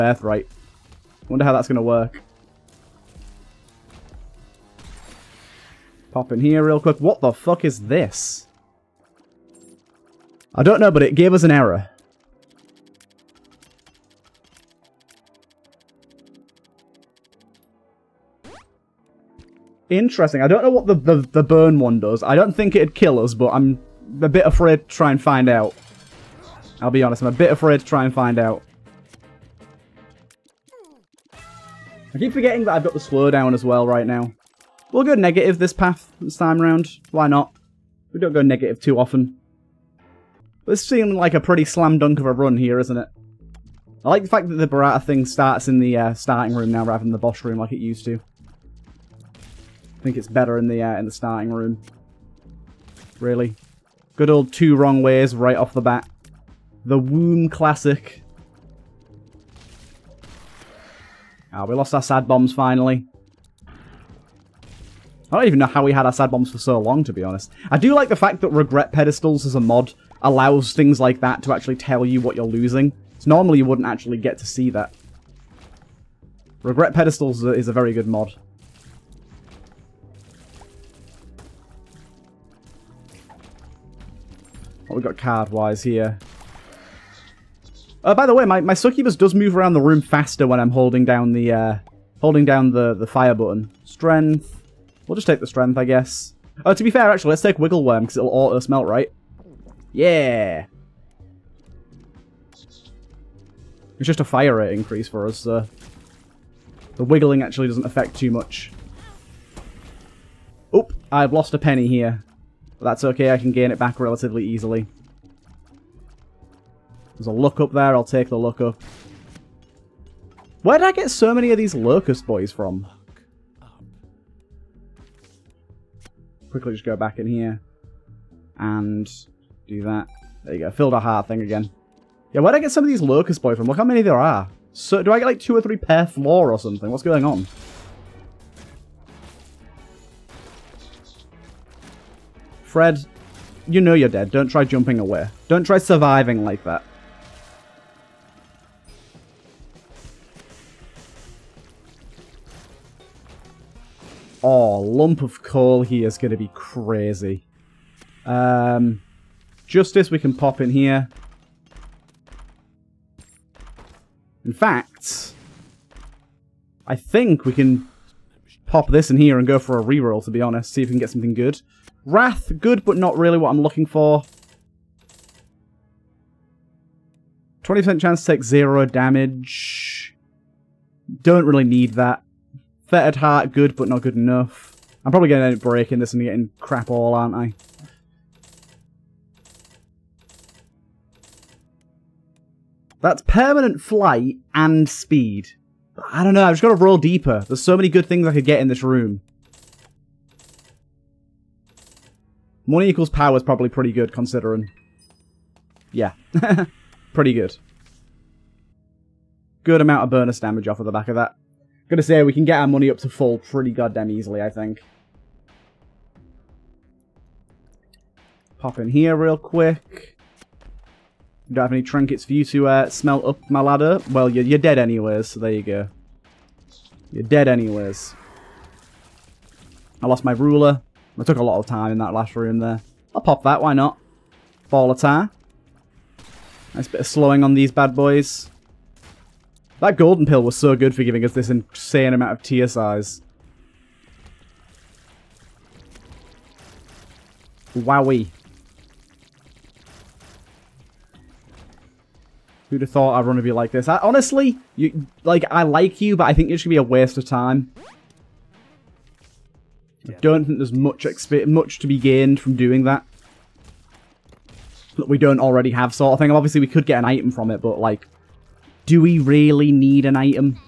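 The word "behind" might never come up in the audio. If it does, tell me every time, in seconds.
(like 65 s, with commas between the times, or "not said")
not said.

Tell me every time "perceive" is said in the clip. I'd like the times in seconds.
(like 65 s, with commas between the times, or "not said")
not said.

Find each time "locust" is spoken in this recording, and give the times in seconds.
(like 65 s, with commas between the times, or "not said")
121 s, 133 s.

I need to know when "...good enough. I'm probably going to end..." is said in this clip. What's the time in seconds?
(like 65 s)
184 s.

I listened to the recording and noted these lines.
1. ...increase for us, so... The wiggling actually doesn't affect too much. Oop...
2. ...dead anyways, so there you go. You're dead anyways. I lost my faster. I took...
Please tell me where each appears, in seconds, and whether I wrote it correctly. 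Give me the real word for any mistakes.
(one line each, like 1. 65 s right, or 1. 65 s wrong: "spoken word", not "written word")
1. 104 s right
2. 224 s wrong: "ruler", not "faster".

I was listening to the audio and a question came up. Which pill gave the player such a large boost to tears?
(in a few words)
golden pill.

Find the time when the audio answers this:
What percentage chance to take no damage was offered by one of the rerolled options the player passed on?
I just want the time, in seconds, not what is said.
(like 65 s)
177 s.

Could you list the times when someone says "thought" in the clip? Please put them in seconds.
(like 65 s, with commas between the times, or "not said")
252 s.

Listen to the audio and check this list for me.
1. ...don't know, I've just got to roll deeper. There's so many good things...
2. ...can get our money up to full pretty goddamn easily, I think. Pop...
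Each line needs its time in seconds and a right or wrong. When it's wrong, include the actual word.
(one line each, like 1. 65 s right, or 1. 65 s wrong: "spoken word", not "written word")
1. 196 s right
2. 212 s right.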